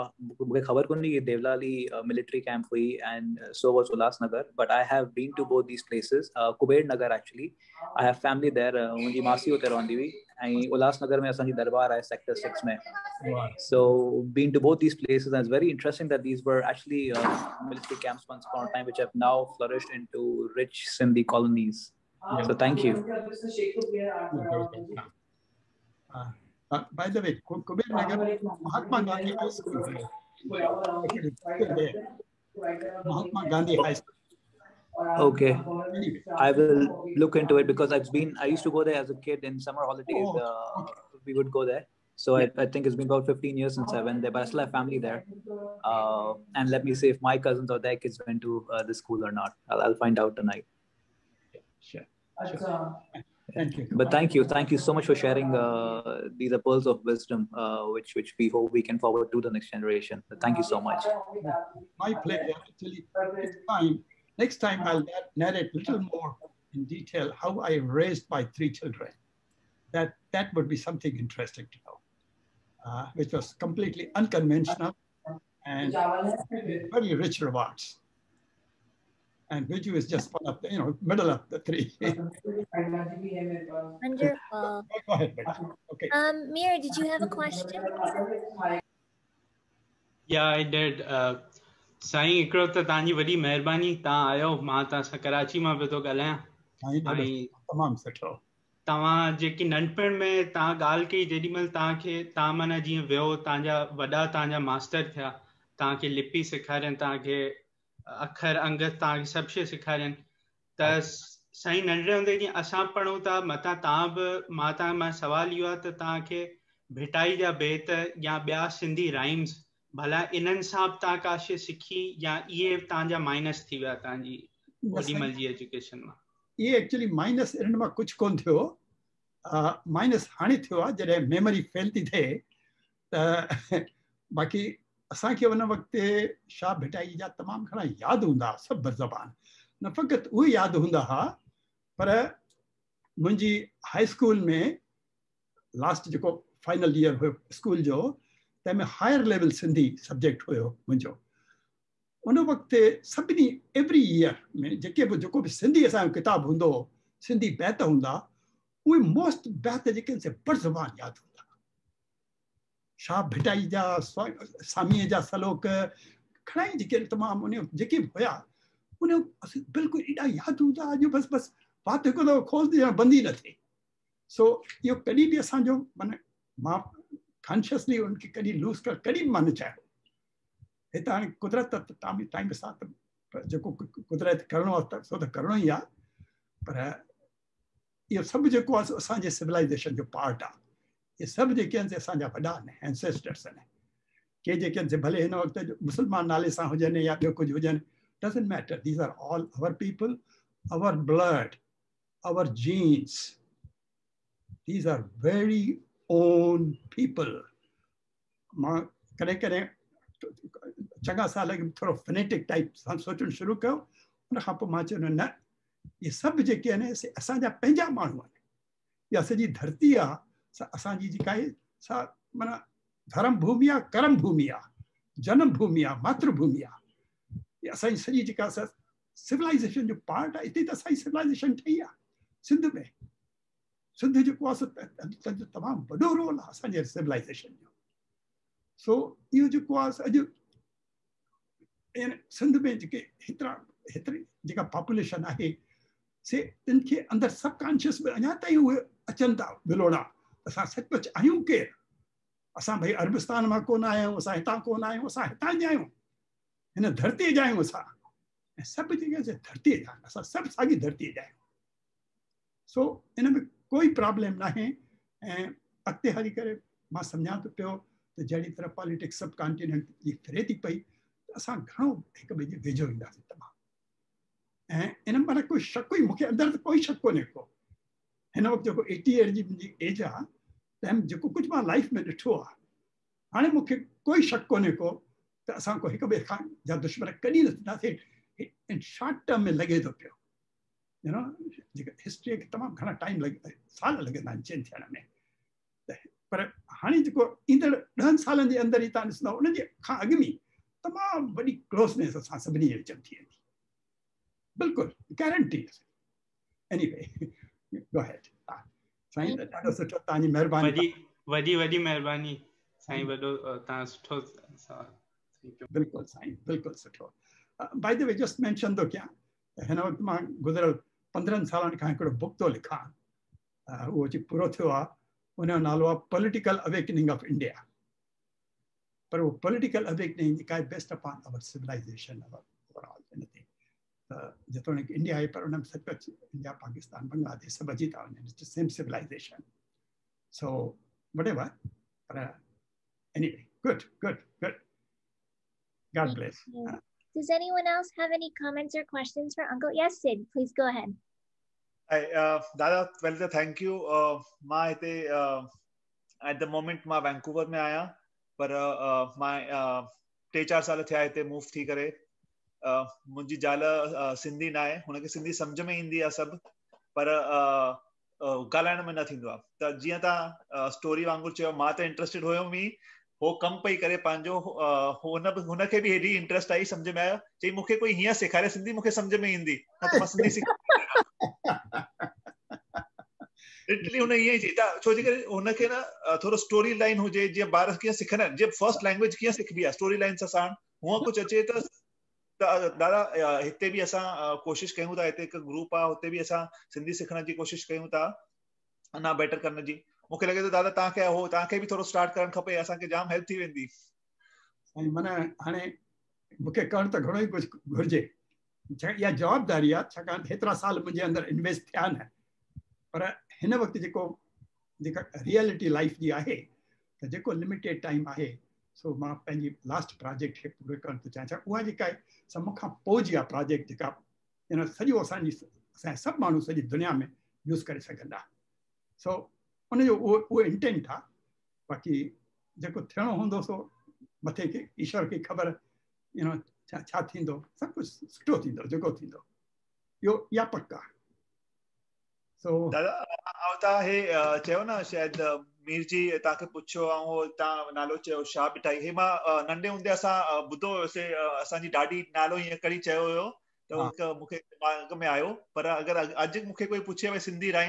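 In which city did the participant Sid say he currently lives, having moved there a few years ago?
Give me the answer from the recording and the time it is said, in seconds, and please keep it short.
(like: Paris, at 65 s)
Vancouver, at 357 s.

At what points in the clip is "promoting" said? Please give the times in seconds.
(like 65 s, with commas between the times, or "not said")
not said.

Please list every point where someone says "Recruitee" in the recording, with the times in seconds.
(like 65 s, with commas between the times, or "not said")
not said.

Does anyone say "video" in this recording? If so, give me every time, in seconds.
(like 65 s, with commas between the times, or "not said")
not said.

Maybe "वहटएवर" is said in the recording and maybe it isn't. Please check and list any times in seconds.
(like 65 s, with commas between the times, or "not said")
341 s.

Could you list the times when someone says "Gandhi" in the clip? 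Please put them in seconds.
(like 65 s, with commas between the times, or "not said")
29 s, 33 s.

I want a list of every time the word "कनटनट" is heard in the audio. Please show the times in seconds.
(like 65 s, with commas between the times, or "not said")
269 s.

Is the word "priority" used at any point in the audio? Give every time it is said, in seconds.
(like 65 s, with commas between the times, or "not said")
not said.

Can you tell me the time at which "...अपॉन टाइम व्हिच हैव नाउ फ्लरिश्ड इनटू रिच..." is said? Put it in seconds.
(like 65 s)
18 s.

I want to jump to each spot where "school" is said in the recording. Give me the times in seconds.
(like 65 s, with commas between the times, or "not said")
29 s, 33 s, 48 s.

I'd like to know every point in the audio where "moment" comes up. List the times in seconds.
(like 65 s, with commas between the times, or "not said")
356 s.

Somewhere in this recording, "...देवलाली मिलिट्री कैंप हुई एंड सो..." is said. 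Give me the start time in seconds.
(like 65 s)
1 s.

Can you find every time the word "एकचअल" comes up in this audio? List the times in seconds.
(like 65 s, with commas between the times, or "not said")
7 s, 16 s, 126 s.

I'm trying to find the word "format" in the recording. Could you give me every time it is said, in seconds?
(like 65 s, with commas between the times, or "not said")
not said.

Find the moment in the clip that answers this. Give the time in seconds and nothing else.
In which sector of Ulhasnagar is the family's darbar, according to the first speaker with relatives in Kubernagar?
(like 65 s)
12 s.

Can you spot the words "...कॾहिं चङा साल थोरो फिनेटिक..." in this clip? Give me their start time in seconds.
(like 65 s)
209 s.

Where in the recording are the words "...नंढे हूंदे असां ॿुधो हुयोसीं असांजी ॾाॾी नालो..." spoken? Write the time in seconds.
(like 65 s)
449 s.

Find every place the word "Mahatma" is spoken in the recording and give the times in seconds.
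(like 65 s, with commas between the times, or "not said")
28 s, 33 s.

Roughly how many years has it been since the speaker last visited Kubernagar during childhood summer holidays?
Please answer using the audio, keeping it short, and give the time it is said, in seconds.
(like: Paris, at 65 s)
15 years, at 43 s.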